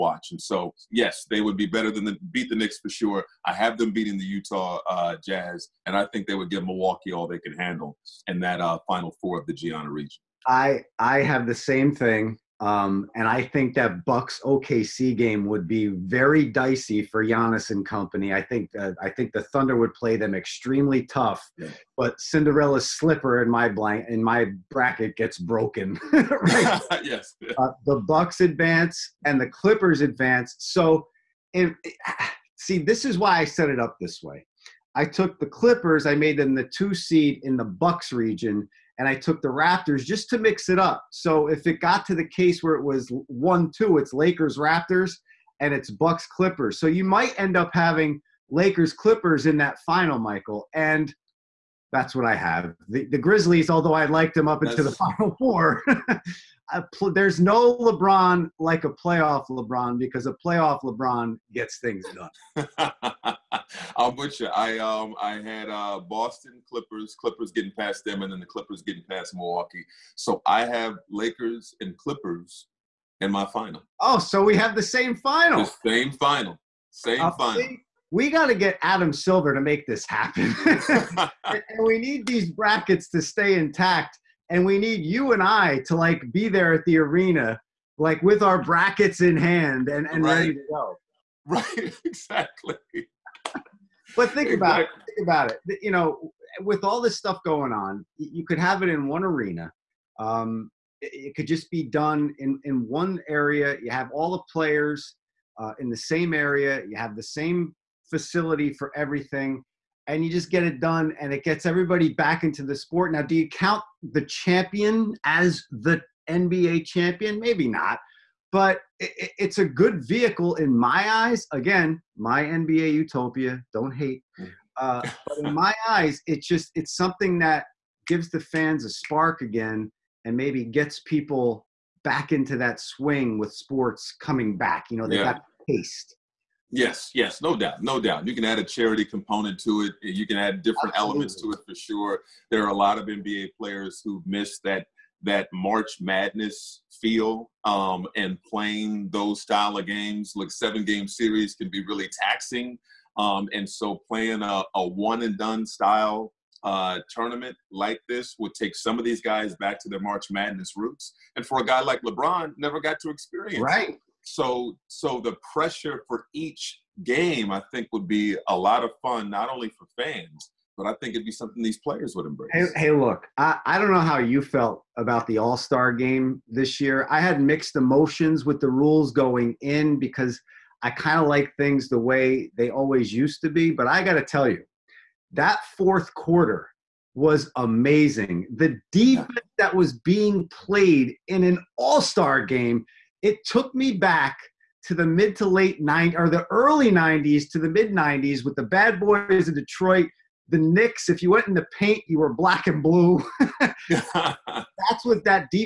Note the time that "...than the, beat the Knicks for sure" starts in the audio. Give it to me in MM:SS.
00:01.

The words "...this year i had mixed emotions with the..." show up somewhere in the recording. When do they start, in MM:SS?
02:56.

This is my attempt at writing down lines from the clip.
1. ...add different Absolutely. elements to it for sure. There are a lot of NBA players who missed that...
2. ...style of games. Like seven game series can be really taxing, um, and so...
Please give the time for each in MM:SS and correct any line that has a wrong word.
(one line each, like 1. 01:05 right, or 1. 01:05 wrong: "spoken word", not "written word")
1. 02:20 right
2. 02:29 right.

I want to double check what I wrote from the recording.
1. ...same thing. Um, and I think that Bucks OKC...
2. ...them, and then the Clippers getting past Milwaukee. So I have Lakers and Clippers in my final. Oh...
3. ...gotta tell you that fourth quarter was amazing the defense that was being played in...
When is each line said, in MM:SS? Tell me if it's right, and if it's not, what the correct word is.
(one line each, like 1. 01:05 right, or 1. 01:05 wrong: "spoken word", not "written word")
1. 00:11 right
2. 01:08 right
3. 03:04 right.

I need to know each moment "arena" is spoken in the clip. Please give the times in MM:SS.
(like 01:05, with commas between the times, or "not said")
01:26, 01:39.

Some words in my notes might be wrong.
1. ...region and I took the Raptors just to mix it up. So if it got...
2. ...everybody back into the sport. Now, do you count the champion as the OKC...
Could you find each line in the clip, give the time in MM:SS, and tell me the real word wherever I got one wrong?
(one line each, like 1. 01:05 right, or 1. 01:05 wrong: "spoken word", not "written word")
1. 00:38 right
2. 01:51 wrong: "NBA", not "OKC".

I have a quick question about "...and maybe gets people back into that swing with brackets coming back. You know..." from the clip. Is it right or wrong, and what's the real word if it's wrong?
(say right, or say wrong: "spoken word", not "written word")
wrong: "sports", not "brackets".